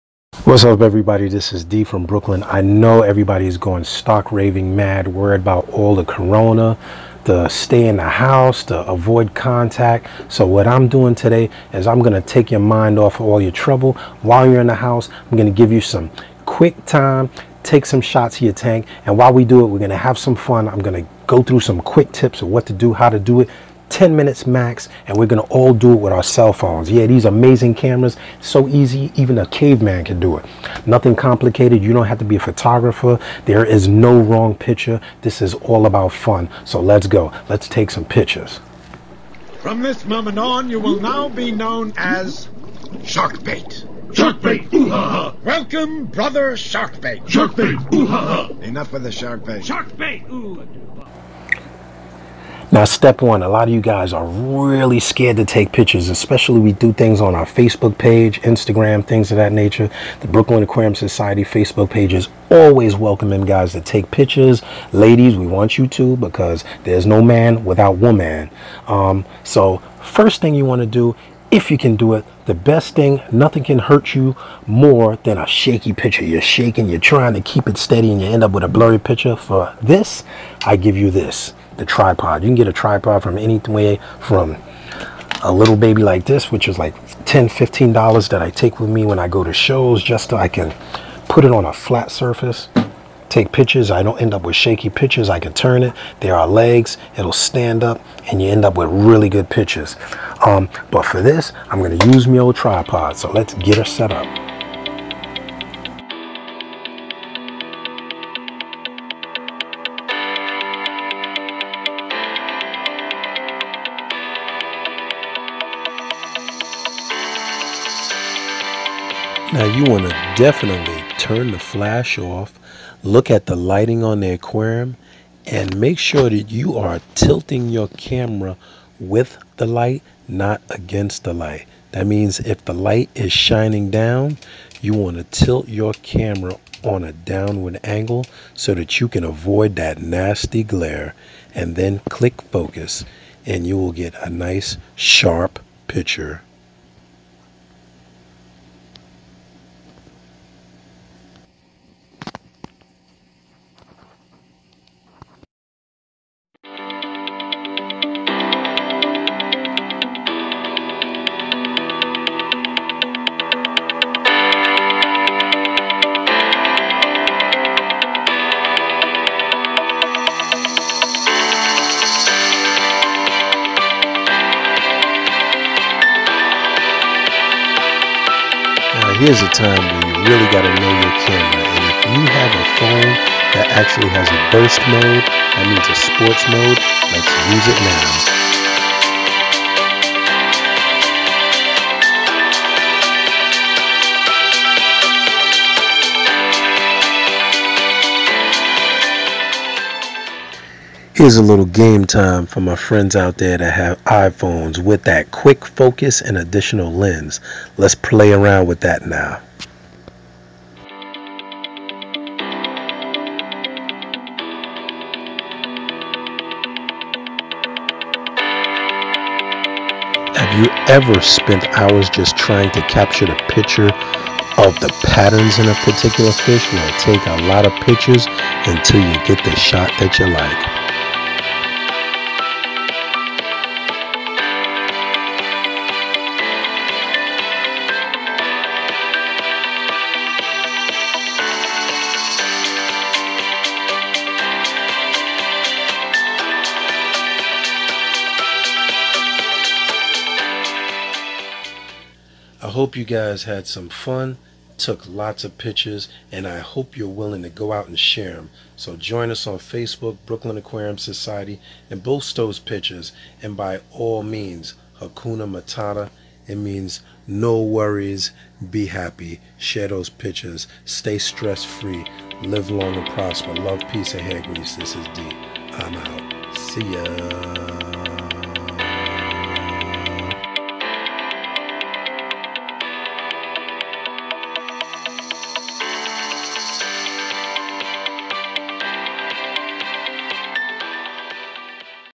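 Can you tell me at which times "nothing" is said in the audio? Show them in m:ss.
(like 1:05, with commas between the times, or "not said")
0:30, 1:13.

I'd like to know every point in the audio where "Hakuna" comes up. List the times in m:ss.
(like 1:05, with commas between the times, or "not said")
4:24.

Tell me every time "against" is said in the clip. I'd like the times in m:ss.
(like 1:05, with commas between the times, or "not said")
2:10.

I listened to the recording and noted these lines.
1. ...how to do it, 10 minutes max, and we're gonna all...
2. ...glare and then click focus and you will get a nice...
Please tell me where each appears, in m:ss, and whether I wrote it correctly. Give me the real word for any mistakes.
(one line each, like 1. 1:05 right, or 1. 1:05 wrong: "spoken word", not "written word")
1. 0:22 right
2. 2:20 right.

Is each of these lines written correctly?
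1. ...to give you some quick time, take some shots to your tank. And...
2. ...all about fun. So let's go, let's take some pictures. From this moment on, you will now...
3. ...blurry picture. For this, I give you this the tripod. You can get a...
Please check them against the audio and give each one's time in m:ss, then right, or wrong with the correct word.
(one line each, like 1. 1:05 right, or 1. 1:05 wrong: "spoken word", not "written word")
1. 0:15 right
2. 0:35 right
3. 1:18 right.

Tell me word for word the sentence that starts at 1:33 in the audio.
I don't end up with shaky pictures.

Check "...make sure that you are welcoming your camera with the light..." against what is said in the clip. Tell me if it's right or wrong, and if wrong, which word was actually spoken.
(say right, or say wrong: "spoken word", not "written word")
wrong: "tilting", not "welcoming".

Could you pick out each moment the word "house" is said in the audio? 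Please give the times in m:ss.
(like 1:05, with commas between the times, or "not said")
0:08, 0:14.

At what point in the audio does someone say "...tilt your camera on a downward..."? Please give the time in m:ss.
2:15.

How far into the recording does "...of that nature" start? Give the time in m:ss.
0:59.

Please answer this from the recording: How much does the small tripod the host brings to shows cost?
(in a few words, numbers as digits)
10-15 dollars.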